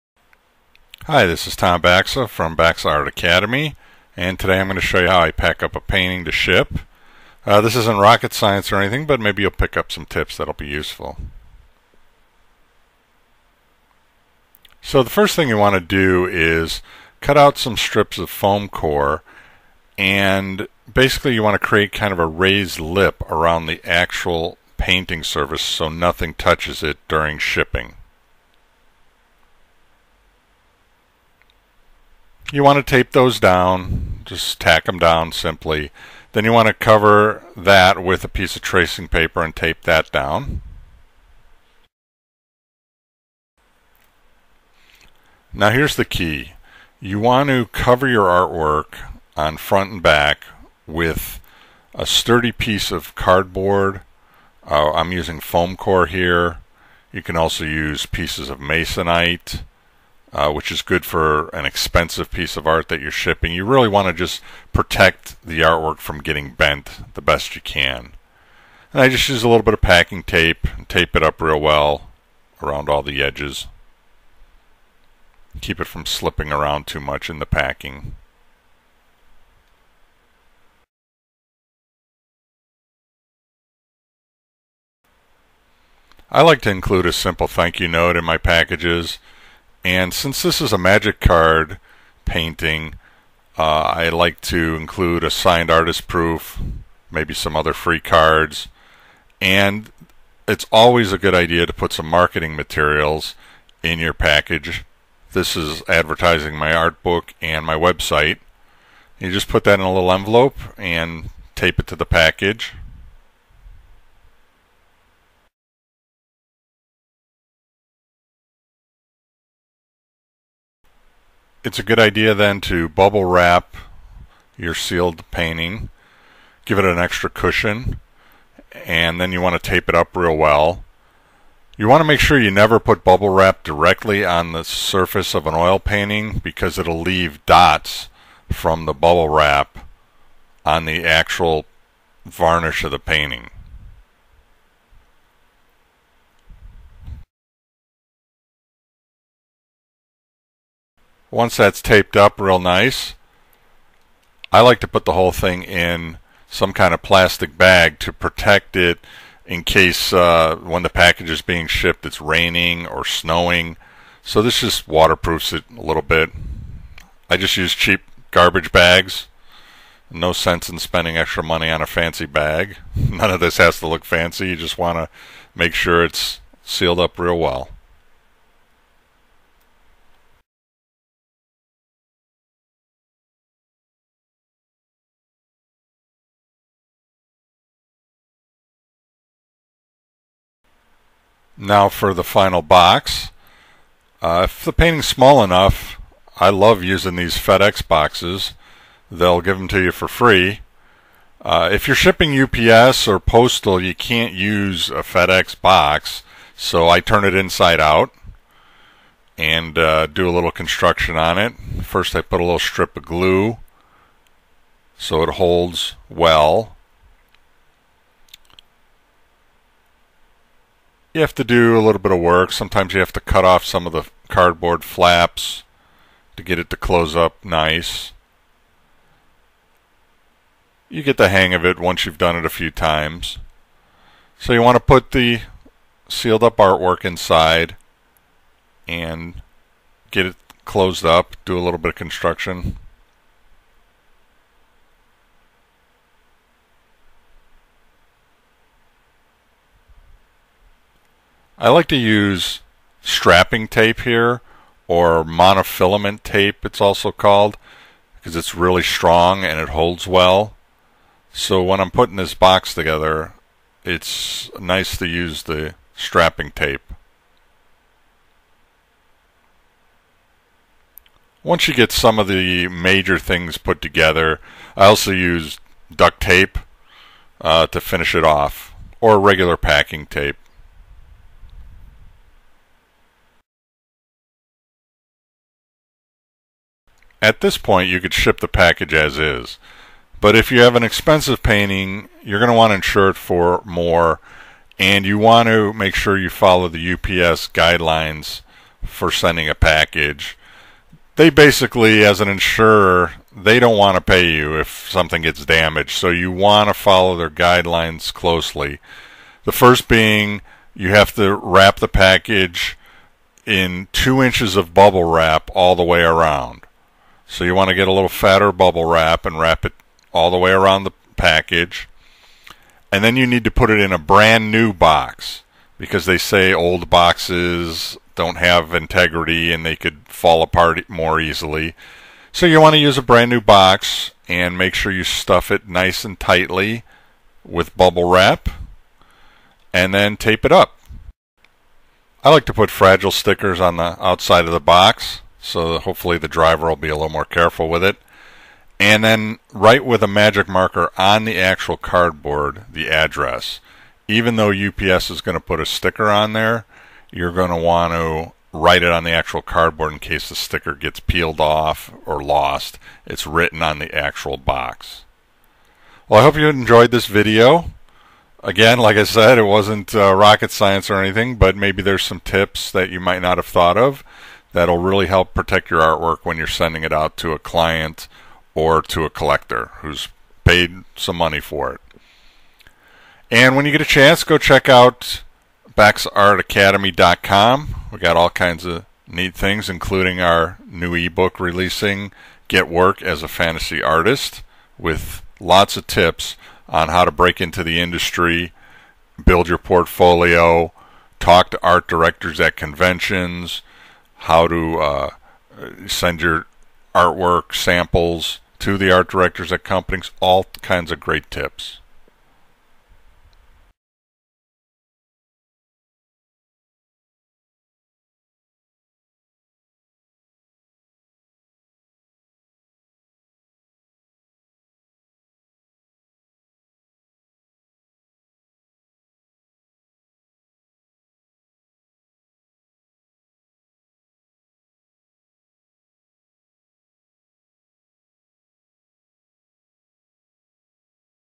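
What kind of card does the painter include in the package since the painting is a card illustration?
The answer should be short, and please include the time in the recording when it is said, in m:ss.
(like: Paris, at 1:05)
signed artist proof, at 1:35.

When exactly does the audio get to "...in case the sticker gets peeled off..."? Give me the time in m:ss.
5:59.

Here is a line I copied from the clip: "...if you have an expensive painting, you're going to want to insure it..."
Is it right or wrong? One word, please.
right.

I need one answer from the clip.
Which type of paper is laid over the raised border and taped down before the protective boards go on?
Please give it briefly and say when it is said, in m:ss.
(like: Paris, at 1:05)
tracing paper, at 0:38.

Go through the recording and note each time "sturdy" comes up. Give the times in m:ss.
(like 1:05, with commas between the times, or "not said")
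0:52.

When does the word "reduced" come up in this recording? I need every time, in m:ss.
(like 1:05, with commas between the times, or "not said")
not said.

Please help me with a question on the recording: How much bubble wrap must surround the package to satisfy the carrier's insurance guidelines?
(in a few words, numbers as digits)
2 inches.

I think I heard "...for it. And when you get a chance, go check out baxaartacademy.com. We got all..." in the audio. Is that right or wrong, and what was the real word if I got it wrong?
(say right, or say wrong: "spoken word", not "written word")
right.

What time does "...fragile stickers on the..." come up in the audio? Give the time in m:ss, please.
5:42.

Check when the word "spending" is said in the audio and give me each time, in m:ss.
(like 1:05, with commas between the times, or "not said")
2:50.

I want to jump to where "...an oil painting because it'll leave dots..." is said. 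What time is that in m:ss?
2:15.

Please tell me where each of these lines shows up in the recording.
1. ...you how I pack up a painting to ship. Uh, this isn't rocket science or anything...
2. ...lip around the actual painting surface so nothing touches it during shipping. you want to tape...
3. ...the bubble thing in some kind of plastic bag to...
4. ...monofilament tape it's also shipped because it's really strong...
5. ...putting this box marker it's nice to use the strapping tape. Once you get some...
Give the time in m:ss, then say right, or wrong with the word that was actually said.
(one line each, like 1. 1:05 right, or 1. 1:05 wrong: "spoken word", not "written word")
1. 0:05 right
2. 0:22 right
3. 2:35 wrong: "whole", not "bubble"
4. 4:15 wrong: "called", not "shipped"
5. 4:21 wrong: "together", not "marker".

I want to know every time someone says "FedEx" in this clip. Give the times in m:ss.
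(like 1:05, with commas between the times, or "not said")
3:17, 3:25.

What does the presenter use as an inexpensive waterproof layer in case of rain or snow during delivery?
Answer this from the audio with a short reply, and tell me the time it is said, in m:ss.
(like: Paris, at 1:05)
garbage bags, at 2:48.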